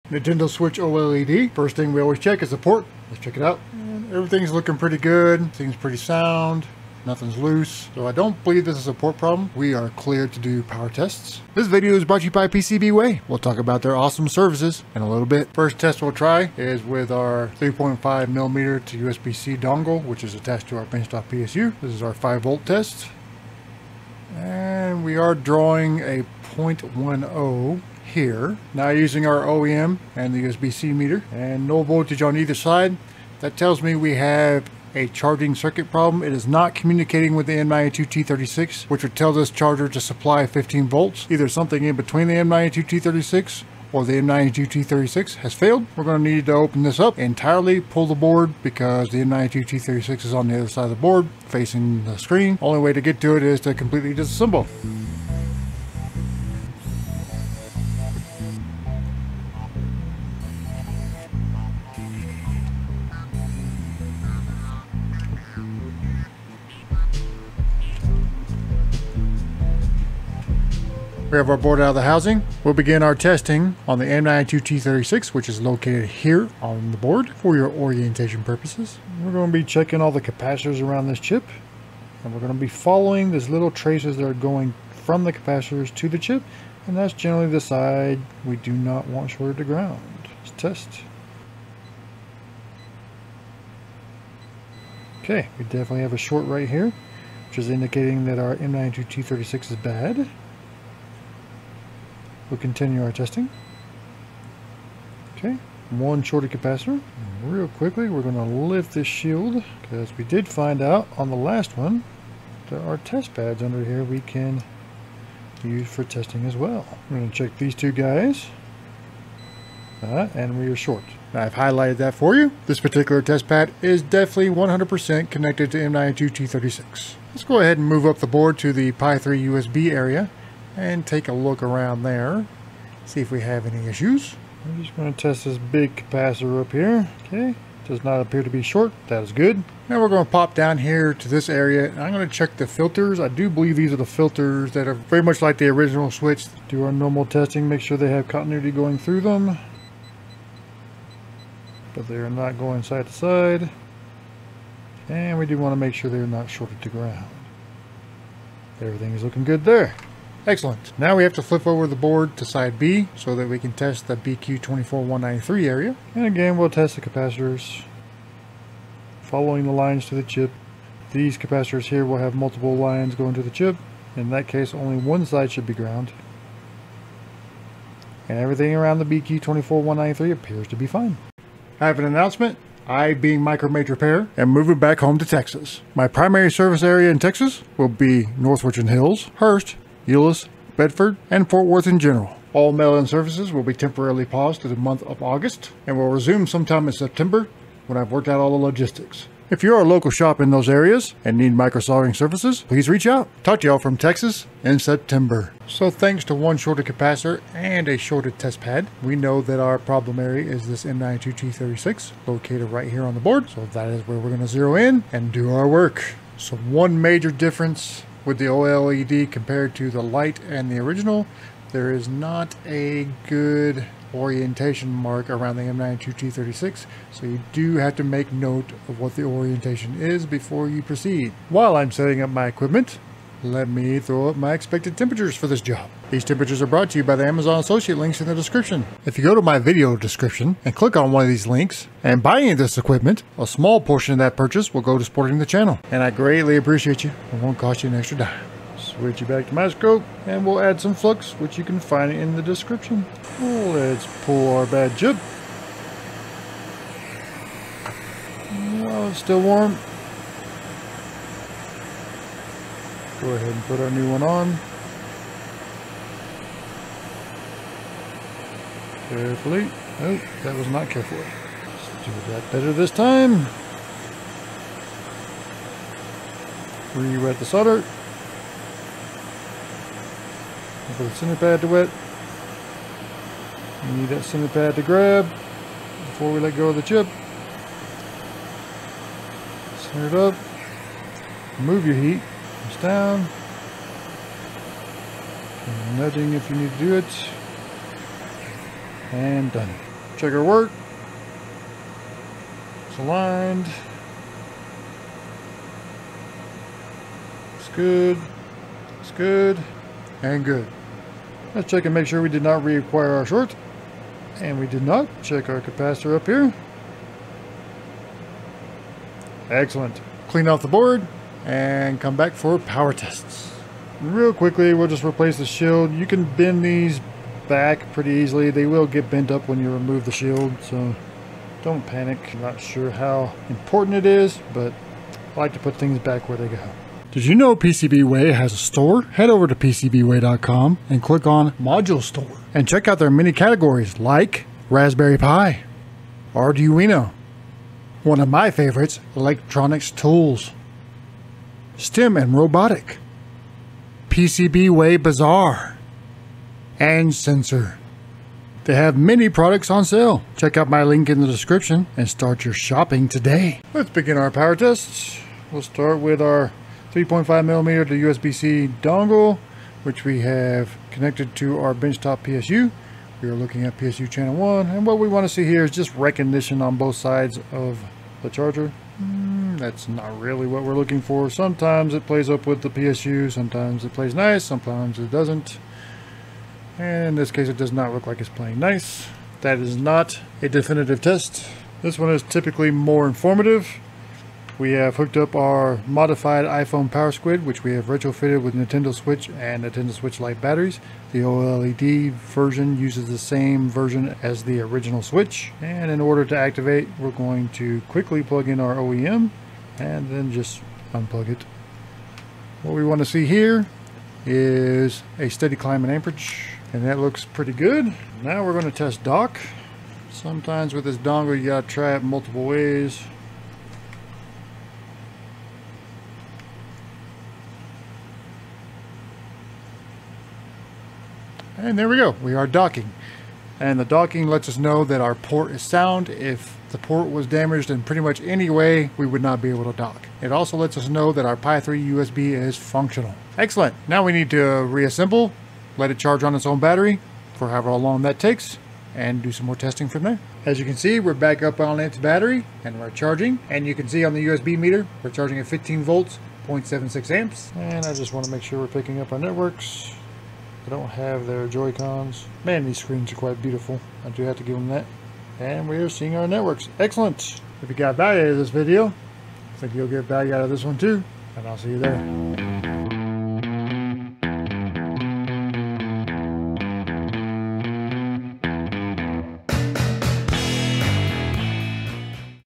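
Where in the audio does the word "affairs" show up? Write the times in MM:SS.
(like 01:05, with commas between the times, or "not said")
not said.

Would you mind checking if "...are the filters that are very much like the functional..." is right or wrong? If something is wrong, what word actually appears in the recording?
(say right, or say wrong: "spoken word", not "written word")
wrong: "original", not "functional".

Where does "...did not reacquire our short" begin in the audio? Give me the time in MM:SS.
05:12.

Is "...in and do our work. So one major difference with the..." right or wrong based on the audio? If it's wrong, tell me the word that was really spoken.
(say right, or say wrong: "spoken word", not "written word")
right.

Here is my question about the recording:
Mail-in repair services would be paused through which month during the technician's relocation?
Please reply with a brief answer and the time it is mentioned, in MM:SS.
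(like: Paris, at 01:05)
August, at 03:15.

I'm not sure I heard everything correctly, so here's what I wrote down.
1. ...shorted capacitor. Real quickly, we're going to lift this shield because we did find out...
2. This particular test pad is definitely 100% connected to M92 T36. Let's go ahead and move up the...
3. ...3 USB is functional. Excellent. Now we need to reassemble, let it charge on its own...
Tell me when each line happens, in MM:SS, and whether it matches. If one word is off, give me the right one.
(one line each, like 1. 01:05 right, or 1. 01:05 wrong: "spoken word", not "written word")
1. 01:46 right
2. 02:02 right
3. 07:21 right.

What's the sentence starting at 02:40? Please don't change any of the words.
Now we have to flip over the board to side B so that we can test the BQ24193 area.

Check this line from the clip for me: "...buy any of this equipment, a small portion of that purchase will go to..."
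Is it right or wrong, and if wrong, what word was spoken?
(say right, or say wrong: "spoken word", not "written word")
right.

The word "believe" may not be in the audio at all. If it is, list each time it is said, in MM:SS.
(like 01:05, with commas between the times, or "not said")
00:08, 02:23.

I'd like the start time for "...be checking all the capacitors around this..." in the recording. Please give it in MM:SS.
01:19.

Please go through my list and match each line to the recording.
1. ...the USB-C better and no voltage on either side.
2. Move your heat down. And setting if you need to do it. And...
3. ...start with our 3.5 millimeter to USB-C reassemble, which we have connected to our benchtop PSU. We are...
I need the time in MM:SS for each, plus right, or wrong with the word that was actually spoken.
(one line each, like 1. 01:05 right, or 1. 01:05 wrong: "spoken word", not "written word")
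1. 00:30 wrong: "meter", not "better"
2. 04:51 wrong: "nudging", not "setting"
3. 06:05 wrong: "dongle", not "reassemble".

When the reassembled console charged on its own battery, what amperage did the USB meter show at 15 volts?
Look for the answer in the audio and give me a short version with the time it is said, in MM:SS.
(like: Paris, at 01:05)
0.76 amps, at 07:36.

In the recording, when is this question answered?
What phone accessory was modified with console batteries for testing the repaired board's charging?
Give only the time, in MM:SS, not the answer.
06:36.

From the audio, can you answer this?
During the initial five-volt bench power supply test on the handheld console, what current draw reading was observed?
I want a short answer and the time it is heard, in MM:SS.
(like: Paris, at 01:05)
0.10, at 00:26.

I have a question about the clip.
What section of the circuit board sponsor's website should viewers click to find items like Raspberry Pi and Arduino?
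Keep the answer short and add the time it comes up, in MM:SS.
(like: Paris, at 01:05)
Module Store, at 05:41.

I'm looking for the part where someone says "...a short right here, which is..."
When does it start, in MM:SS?
01:36.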